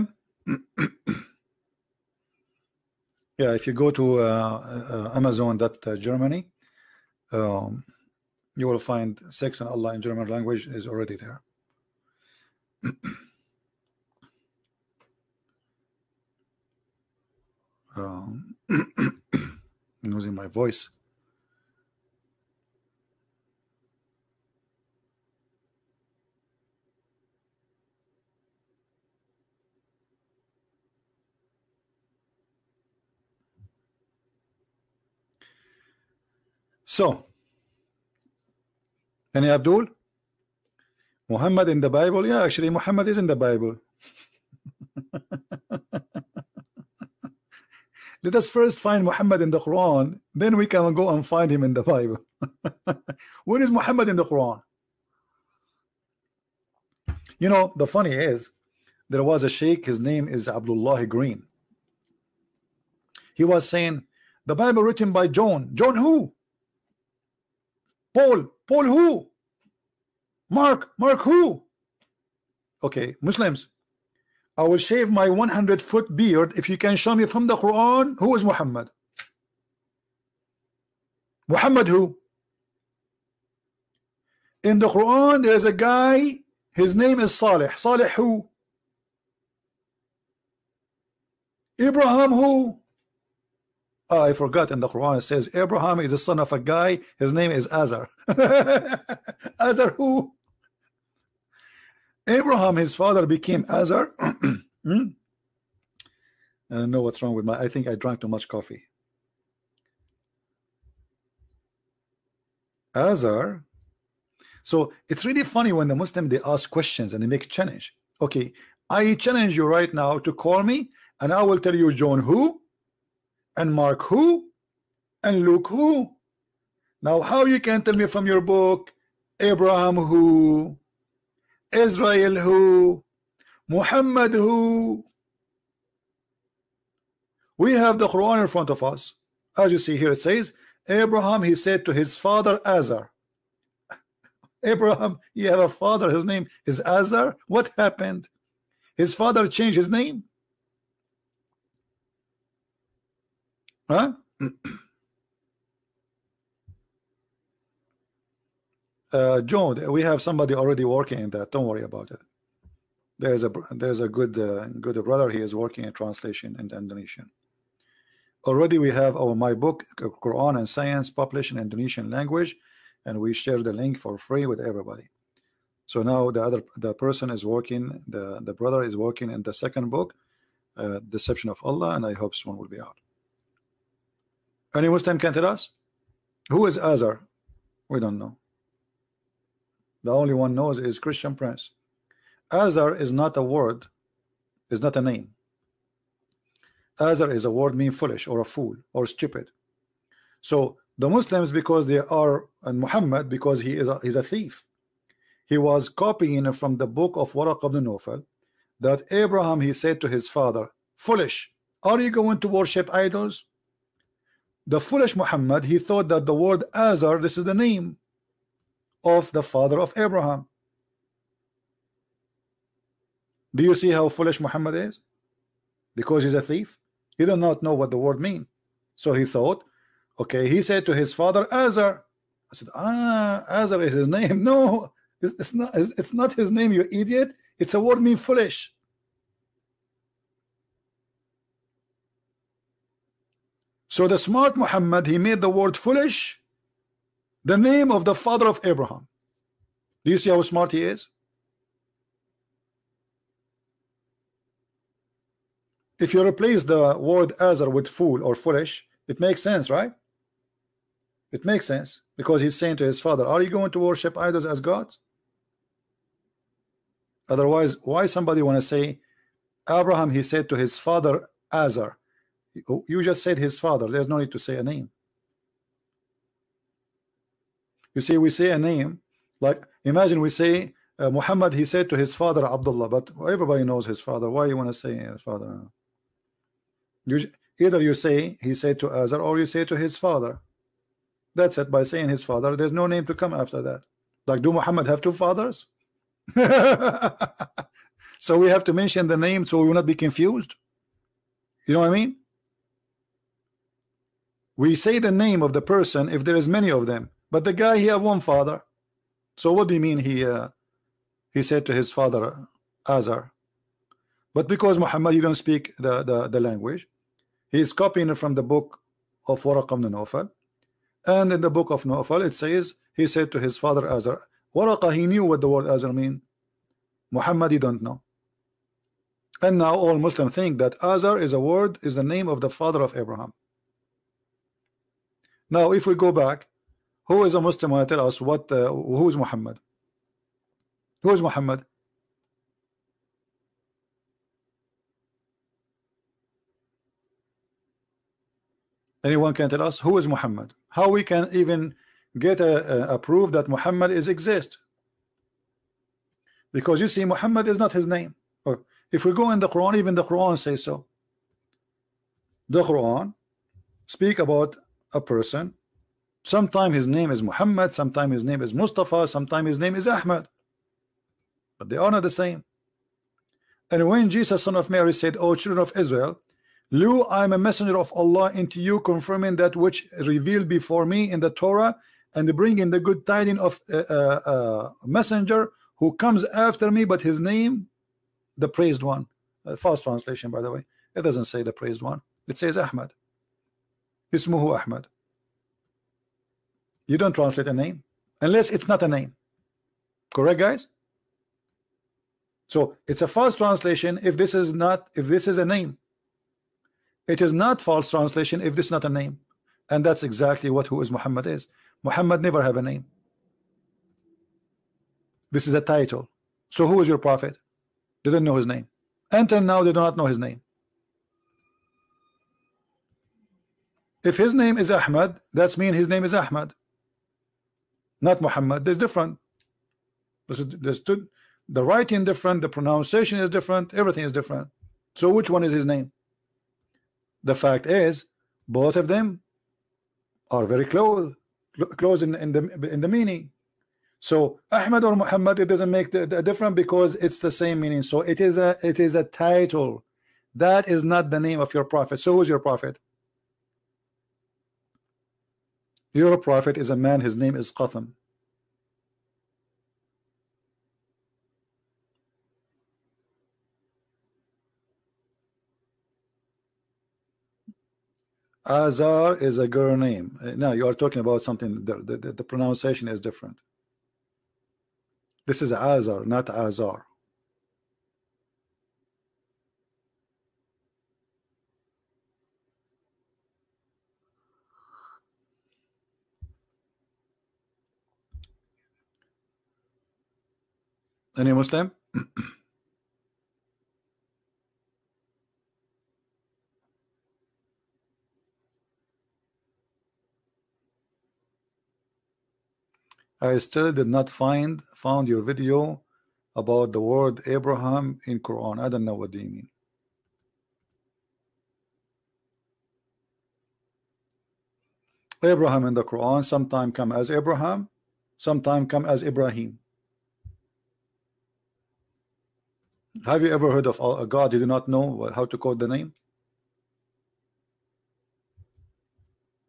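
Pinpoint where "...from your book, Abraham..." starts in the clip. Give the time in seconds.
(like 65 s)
128 s.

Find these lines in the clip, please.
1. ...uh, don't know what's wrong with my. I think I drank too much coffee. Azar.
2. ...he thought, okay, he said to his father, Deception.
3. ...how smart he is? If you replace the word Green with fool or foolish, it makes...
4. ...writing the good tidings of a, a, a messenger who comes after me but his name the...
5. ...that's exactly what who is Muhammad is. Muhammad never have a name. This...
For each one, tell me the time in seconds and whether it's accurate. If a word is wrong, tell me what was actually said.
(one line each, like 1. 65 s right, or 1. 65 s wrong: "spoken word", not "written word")
1. 106 s right
2. 229 s wrong: "Azar", not "Deception"
3. 250 s wrong: "Azar", not "Green"
4. 382 s wrong: "bringing", not "writing"
5. 409 s right.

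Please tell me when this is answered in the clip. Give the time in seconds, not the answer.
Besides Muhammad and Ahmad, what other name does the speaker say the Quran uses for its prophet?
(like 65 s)
368 s.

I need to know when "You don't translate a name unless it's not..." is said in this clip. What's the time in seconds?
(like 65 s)
396 s.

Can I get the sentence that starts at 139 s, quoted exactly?
As you see here, it says, Abraham, he said to his father, Azar.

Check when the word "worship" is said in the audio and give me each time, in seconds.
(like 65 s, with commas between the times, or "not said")
212 s, 263 s.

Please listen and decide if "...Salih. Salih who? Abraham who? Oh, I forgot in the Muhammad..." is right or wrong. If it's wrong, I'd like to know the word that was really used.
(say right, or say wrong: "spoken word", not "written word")
wrong: "Quran", not "Muhammad".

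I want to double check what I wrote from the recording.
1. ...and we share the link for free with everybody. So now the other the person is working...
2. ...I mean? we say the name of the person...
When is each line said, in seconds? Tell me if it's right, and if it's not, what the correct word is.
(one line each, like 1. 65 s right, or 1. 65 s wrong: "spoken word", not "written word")
1. 173 s right
2. 301 s right.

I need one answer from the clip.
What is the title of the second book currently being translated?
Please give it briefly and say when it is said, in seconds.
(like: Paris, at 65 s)
Deception of Allah, at 181 s.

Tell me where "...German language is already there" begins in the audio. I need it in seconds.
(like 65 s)
10 s.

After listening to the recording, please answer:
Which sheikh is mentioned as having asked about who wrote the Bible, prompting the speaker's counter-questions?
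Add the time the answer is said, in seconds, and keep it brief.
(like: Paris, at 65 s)
Abdullah Green, at 60 s.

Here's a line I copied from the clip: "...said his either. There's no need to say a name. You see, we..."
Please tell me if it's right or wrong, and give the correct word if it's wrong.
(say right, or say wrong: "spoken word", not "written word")
wrong: "father", not "either".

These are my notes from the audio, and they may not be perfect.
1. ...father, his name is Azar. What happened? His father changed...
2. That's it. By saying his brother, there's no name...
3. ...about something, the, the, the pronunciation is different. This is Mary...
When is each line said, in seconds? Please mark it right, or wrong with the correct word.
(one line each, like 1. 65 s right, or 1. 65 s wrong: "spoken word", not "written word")
1. 145 s right
2. 291 s wrong: "father", not "brother"
3. 470 s wrong: "Azar", not "Mary".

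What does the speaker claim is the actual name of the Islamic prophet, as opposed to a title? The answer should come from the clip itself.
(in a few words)
Qatham.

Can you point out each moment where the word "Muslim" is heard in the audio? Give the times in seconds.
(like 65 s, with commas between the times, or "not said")
73 s, 115 s, 184 s, 201 s, 329 s, 337 s, 491 s.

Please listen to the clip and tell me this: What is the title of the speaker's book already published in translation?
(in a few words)
Quran and Science.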